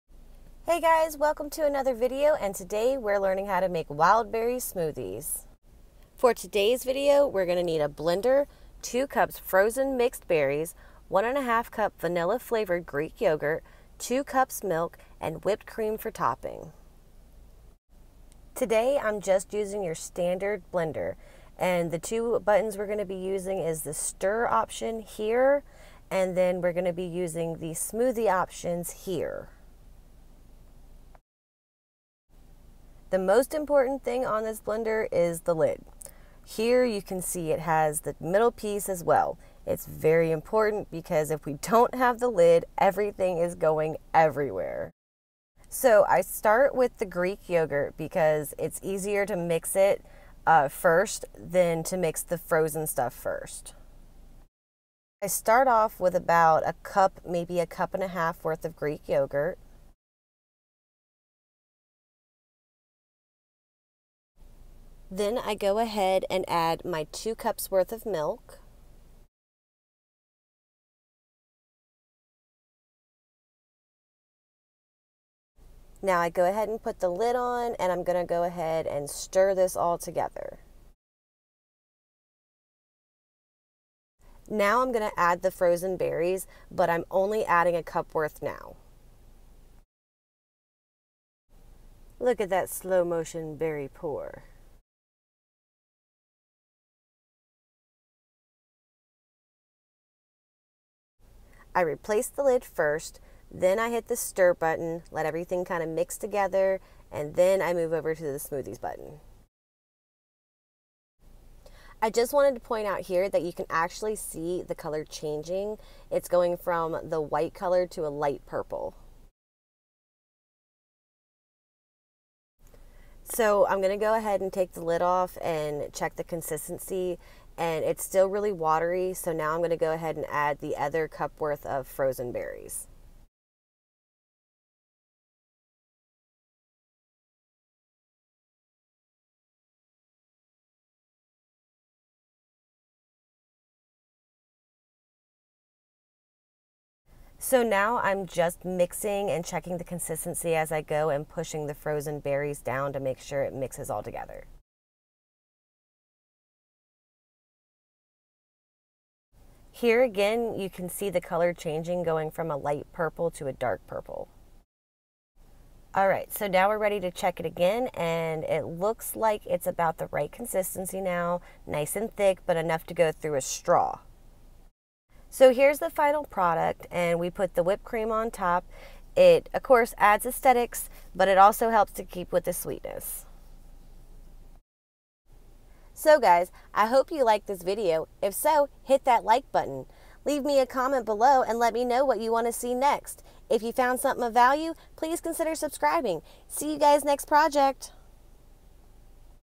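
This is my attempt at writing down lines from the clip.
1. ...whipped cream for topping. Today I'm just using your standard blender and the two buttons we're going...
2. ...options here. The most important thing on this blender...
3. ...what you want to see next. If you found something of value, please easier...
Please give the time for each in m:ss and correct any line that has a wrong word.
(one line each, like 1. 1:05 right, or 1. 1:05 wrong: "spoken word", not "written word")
1. 0:15 right
2. 0:28 right
3. 3:12 wrong: "consider", not "easier".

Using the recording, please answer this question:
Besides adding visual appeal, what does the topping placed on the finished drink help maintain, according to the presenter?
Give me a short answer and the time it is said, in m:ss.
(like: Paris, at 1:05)
sweetness, at 3:02.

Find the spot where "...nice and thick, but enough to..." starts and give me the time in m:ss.
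2:51.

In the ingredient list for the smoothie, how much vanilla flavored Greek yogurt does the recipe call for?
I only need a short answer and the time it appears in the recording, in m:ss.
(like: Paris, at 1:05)
1.5 cups, at 0:11.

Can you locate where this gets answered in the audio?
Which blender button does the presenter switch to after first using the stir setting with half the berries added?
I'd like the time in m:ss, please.
1:48.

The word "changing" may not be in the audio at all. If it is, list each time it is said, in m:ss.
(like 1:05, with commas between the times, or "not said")
1:55, 2:41.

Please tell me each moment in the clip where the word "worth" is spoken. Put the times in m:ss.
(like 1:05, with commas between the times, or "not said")
0:58, 1:07, 1:28, 2:11.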